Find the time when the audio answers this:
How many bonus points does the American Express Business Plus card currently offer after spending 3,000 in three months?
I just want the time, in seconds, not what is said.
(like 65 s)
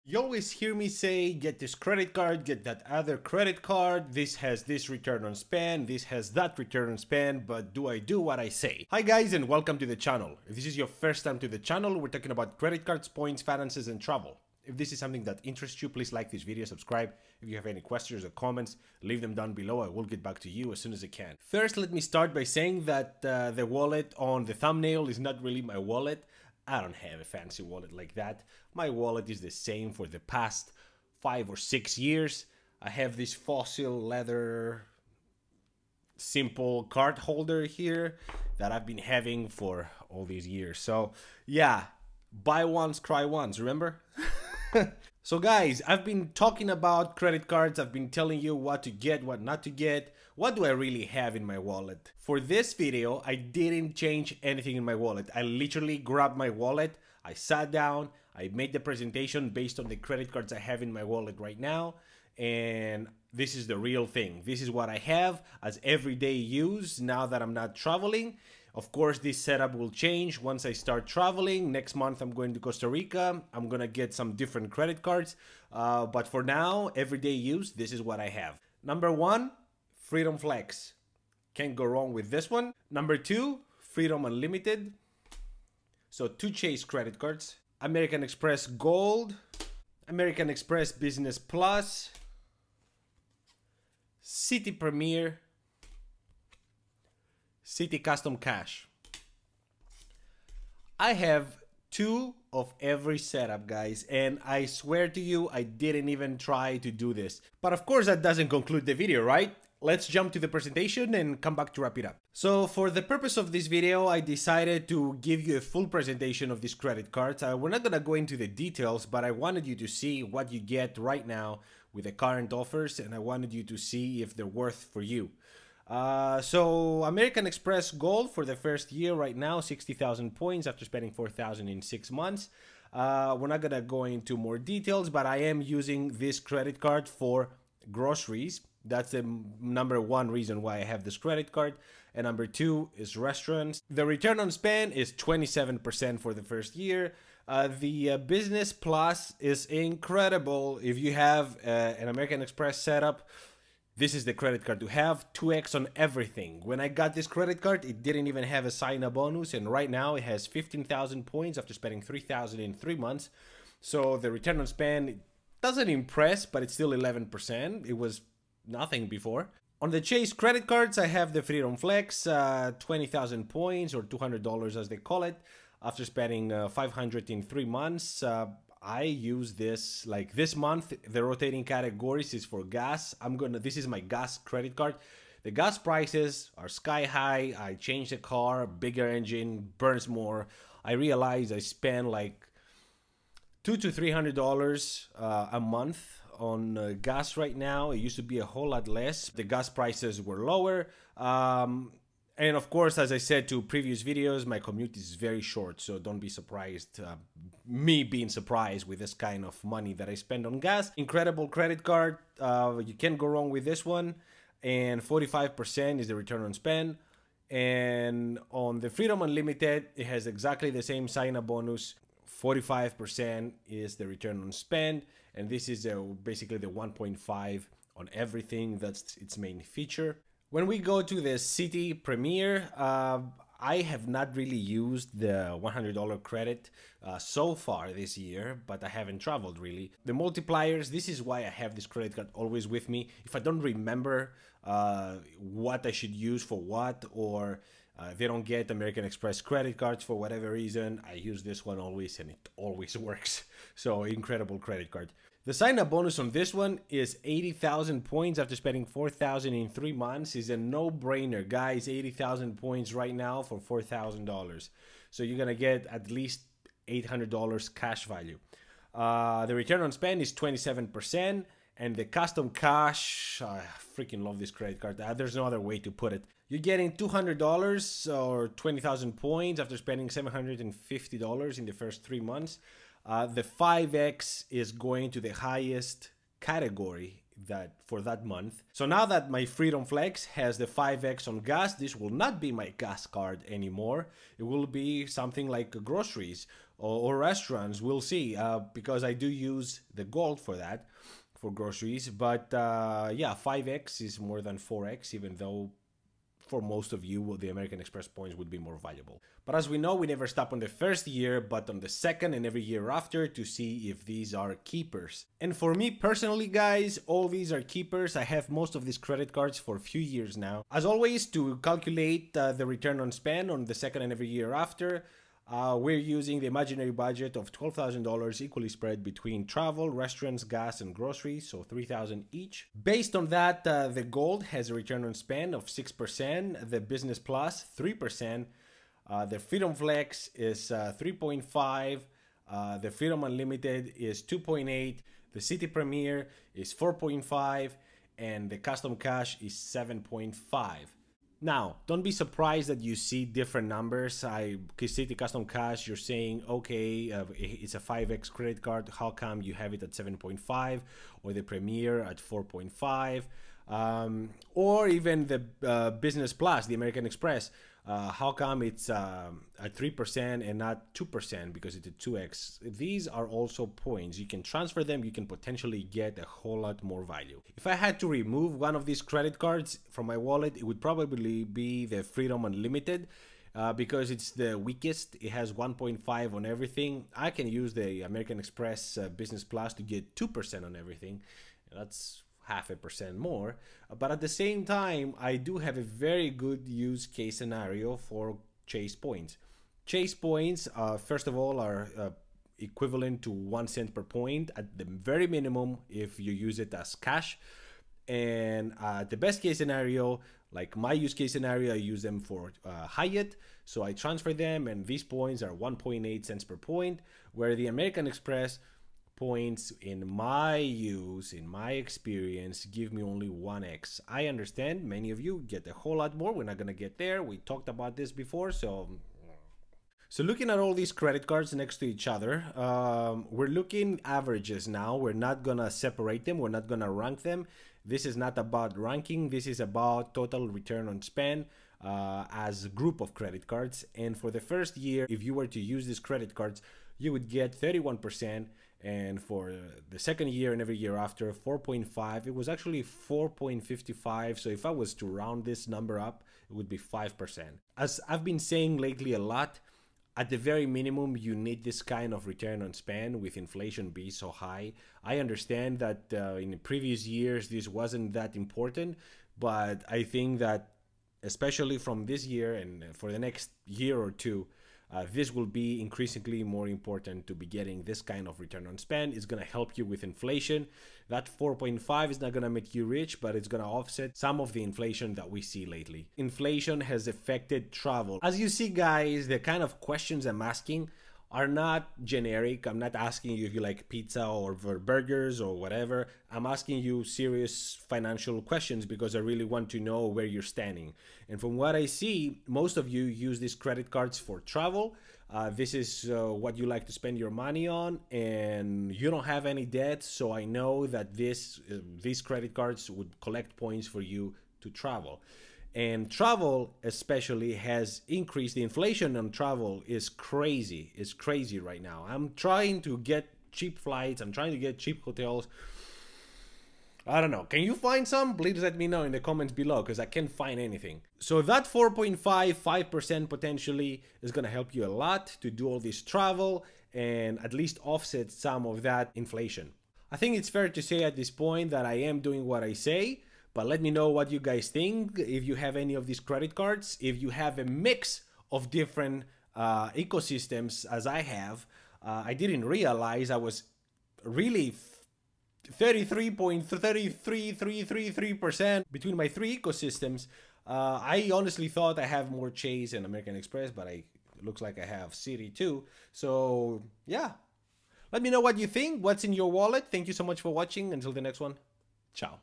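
160 s.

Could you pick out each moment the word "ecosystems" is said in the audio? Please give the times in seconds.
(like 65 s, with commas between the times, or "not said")
549 s, 559 s.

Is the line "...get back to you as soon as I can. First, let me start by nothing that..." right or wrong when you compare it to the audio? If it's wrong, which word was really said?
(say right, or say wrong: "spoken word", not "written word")
wrong: "saying", not "nothing".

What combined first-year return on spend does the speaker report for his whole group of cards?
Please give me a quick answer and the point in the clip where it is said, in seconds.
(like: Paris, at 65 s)
31%, at 447 s.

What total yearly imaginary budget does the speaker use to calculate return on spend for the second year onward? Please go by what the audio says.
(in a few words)
$12,000.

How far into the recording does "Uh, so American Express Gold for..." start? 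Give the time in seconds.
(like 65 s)
125 s.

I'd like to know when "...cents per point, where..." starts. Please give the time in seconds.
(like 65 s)
416 s.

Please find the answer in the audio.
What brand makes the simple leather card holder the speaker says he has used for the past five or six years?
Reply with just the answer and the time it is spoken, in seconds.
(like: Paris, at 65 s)
Fossil, at 33 s.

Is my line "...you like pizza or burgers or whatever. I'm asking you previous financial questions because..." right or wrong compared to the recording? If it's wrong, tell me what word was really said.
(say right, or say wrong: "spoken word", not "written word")
wrong: "serious", not "previous".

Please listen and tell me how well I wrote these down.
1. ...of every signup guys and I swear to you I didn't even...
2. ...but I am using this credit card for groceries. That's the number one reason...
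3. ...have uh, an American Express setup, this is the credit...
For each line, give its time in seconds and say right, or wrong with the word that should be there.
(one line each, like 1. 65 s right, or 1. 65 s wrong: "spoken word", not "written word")
1. 102 s wrong: "setup", not "signup"
2. 135 s right
3. 151 s right.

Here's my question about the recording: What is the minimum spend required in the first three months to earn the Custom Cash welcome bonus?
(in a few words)
$750.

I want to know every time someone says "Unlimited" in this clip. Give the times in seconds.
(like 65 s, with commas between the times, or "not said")
84 s, 219 s, 343 s, 382 s.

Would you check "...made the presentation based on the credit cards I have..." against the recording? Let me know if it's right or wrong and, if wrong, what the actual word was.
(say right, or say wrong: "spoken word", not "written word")
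right.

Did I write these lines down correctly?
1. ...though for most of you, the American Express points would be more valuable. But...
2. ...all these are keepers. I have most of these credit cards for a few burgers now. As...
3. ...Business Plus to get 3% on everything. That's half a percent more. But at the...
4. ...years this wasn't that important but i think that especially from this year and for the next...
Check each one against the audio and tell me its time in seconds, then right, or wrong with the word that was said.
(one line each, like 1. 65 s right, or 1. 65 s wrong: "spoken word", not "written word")
1. 305 s right
2. 317 s wrong: "years", not "burgers"
3. 389 s wrong: "2", not "3"
4. 467 s right.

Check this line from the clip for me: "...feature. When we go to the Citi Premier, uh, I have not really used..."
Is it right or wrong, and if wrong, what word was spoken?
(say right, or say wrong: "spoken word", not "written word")
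right.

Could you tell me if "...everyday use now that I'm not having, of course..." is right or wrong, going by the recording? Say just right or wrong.
wrong.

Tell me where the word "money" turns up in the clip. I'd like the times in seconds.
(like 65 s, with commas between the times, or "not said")
209 s, 507 s.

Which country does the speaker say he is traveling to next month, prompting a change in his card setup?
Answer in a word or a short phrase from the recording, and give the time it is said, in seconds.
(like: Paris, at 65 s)
Costa Rica, at 72 s.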